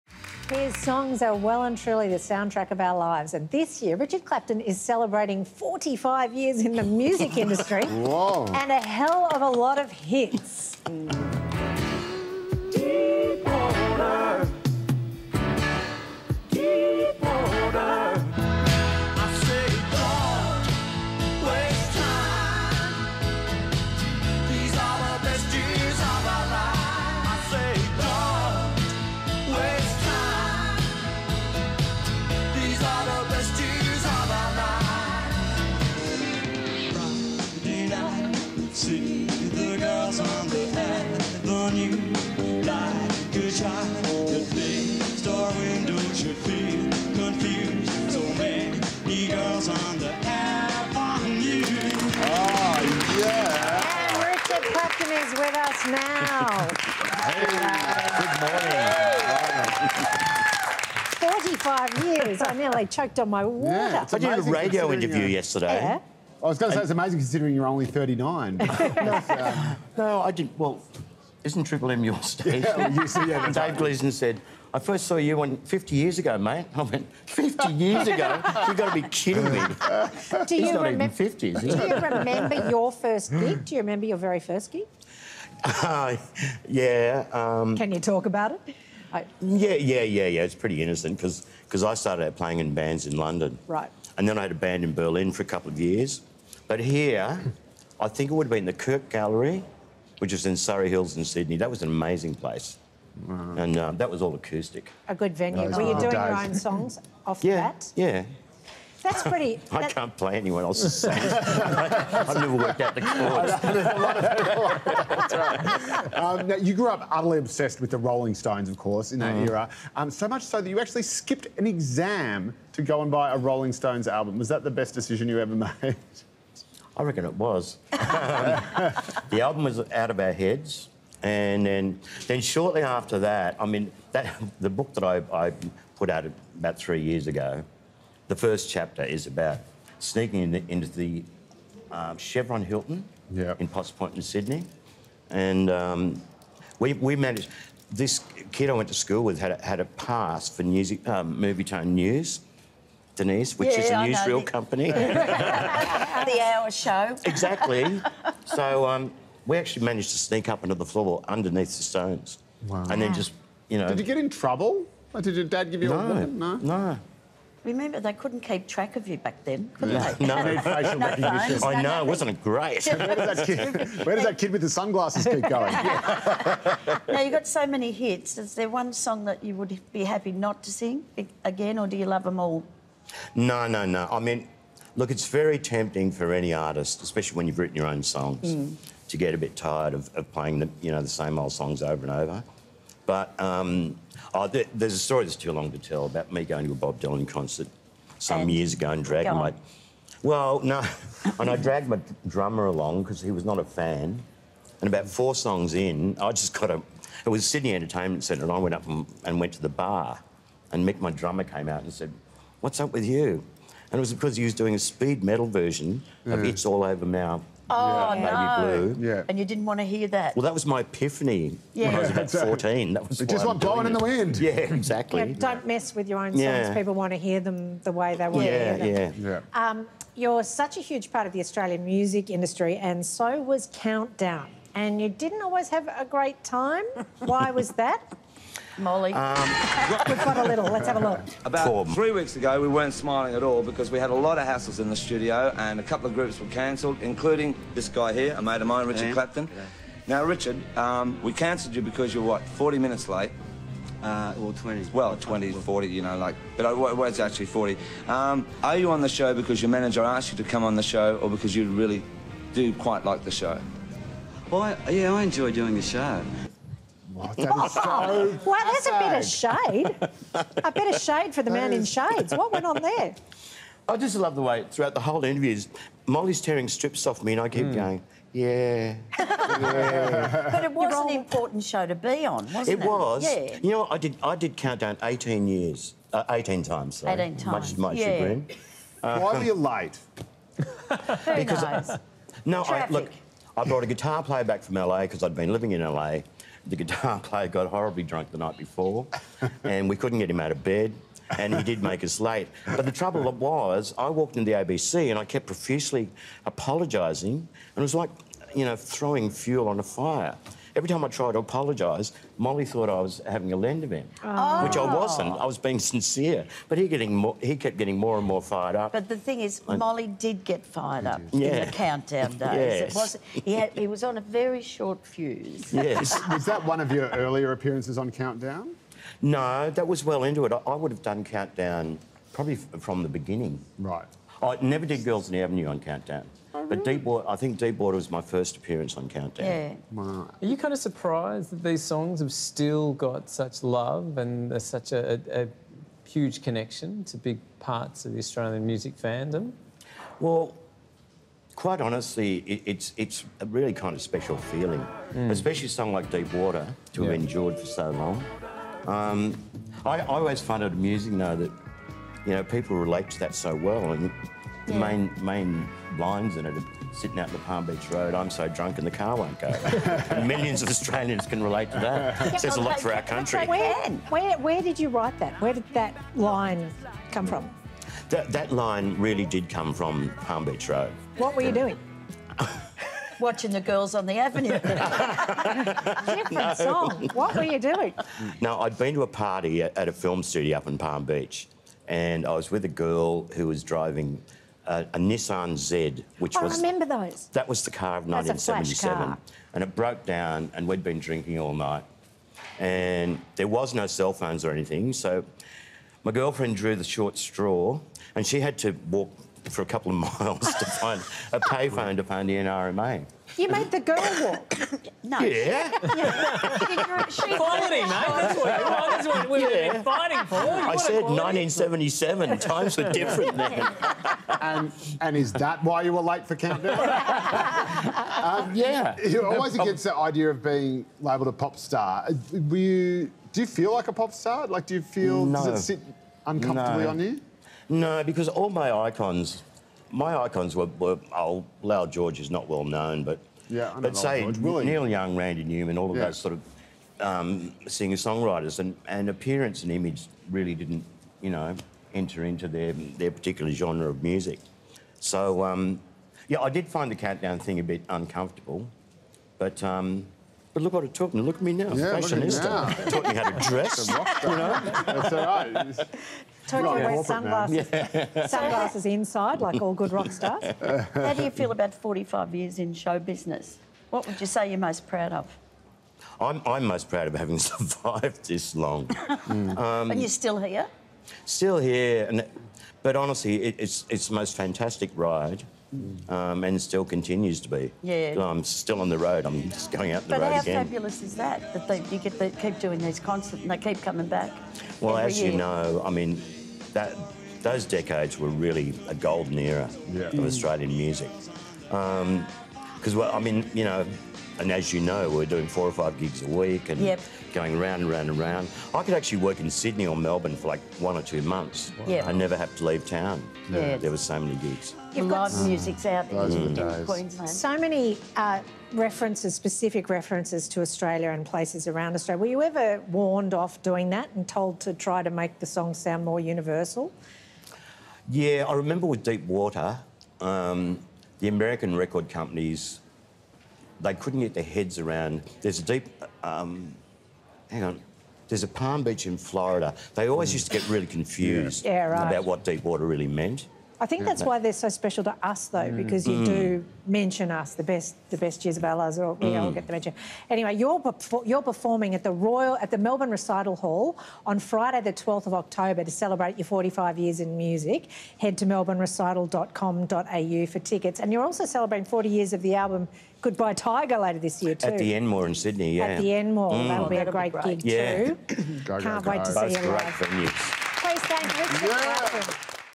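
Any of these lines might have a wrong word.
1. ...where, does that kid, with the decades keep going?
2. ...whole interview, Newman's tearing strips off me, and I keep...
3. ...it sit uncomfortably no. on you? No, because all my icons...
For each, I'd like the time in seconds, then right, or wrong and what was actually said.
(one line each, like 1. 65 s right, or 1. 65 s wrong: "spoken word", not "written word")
1. 174 s wrong: "sunglasses", not "decades"
2. 275 s wrong: "Molly", not "Newman"
3. 435 s right.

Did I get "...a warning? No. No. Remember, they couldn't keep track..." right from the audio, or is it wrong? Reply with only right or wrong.
right.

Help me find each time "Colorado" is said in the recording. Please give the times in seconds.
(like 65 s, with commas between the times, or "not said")
not said.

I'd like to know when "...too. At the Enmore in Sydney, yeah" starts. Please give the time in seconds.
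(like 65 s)
564 s.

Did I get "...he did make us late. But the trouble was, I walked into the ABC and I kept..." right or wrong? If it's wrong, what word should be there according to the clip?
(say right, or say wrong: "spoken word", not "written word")
right.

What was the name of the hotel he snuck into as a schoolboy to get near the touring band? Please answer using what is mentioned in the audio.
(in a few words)
Chevron Hilton.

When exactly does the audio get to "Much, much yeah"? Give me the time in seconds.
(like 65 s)
287 s.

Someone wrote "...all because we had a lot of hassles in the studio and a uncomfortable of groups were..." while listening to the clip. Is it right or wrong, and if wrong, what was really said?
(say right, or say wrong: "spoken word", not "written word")
wrong: "couple", not "uncomfortable".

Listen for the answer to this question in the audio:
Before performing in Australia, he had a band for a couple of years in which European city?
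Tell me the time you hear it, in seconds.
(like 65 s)
94 s.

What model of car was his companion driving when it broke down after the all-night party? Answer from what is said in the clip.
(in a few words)
Nissan Z.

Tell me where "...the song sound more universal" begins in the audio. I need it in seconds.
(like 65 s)
525 s.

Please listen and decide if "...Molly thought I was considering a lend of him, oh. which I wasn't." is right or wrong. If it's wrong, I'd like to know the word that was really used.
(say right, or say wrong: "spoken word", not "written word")
wrong: "having", not "considering".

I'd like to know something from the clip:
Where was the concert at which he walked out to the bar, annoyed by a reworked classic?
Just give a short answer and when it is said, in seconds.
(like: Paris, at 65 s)
Sydney Entertainment Centre, at 207 s.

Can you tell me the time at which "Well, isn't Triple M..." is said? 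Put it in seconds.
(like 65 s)
70 s.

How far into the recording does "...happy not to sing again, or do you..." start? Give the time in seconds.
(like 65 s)
180 s.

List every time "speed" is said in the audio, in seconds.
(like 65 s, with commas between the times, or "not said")
214 s.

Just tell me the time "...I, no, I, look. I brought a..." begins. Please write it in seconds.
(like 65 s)
291 s.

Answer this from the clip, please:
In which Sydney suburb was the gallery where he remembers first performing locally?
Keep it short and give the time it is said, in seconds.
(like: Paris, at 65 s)
Surry Hills, at 100 s.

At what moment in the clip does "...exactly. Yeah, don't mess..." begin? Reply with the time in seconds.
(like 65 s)
224 s.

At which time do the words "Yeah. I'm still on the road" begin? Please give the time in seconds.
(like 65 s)
487 s.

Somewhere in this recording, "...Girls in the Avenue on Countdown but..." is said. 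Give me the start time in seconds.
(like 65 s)
335 s.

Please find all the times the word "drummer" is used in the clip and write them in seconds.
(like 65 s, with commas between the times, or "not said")
202 s, 211 s.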